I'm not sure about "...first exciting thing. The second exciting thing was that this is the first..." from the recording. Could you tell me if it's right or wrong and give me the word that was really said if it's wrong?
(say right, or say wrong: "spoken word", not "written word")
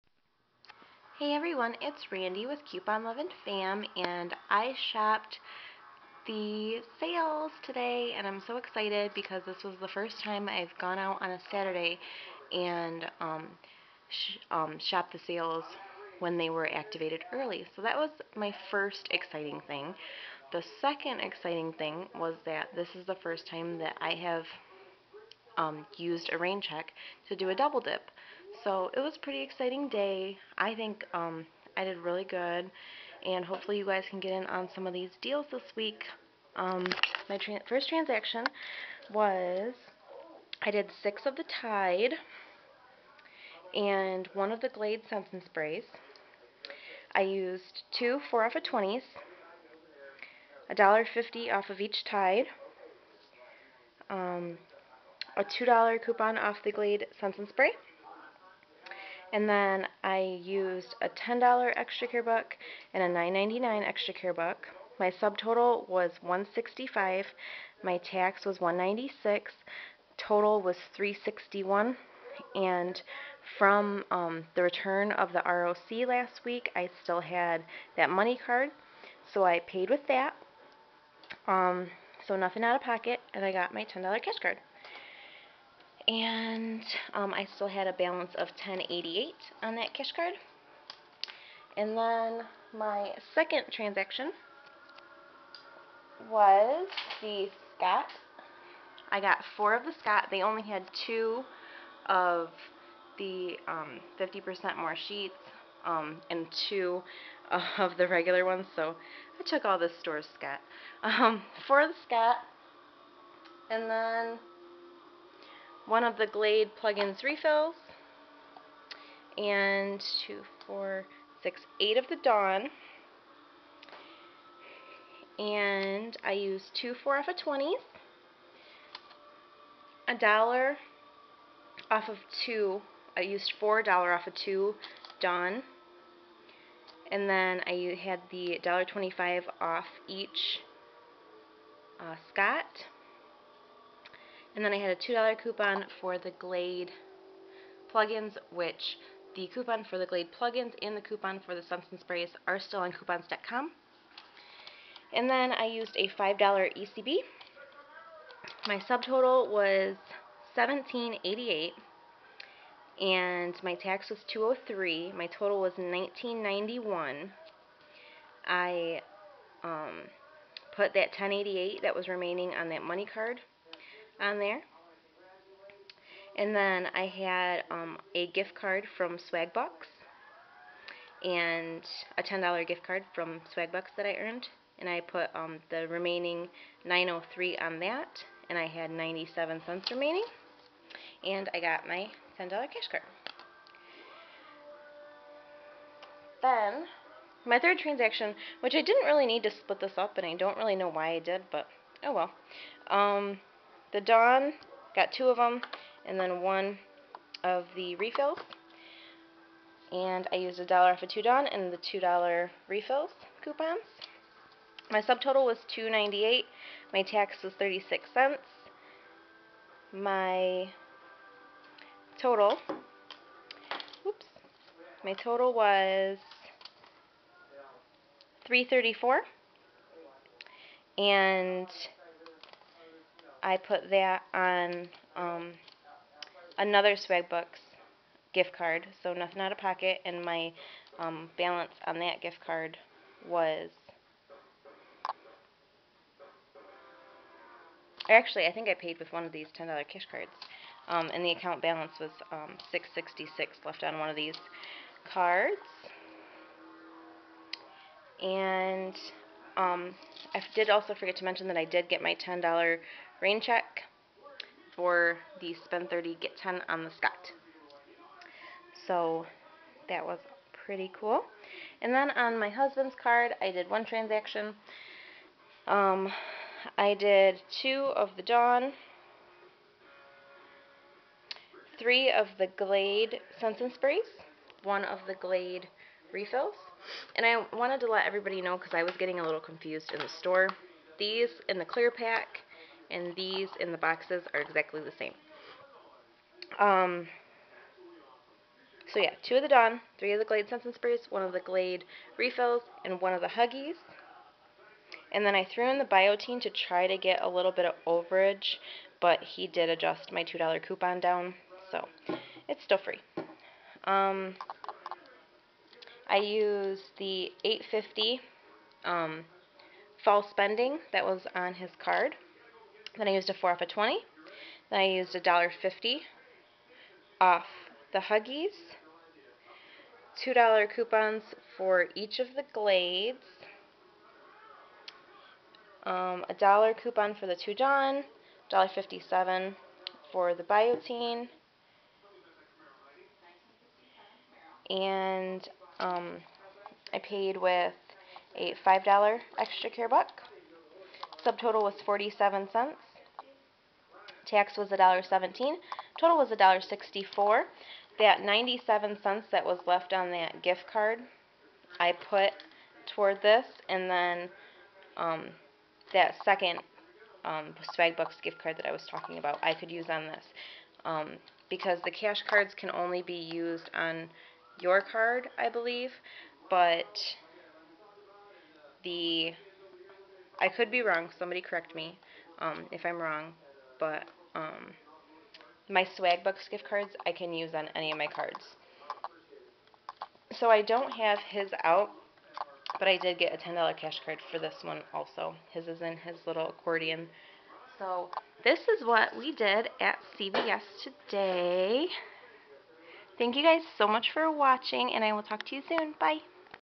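right.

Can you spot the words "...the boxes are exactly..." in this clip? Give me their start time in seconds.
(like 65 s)
293 s.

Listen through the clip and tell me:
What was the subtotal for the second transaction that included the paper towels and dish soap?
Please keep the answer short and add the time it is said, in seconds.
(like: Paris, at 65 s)
$17.88, at 160 s.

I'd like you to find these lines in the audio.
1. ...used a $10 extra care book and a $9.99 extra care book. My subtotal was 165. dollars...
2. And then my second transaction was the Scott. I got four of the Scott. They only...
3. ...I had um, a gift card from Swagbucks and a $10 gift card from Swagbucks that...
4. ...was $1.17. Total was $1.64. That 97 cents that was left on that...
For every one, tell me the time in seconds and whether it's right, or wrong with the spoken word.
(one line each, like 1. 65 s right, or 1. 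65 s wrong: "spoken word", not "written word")
1. 60 s right
2. 91 s right
3. 176 s right
4. 354 s right.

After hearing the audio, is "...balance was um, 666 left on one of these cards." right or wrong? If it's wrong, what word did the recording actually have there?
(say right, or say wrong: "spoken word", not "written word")
right.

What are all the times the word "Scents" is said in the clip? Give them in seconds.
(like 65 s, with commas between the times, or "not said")
45 s, 57 s, 283 s, 300 s.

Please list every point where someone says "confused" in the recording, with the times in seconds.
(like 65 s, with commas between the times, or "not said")
289 s.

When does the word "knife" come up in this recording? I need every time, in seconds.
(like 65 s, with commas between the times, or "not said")
not said.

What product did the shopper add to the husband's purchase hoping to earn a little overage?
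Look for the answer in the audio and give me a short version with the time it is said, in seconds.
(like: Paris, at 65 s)
Biotin, at 305 s.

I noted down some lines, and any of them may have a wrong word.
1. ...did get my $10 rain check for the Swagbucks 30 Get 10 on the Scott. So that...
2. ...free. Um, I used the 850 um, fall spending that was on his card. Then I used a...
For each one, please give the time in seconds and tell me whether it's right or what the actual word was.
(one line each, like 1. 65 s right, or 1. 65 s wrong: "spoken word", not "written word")
1. 261 s wrong: "Spend", not "Swagbucks"
2. 312 s right.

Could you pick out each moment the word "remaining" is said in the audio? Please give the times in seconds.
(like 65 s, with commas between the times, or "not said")
172 s, 185 s, 189 s.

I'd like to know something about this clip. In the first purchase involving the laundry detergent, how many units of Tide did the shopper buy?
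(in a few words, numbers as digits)
6.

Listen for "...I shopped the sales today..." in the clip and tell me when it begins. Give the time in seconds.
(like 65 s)
4 s.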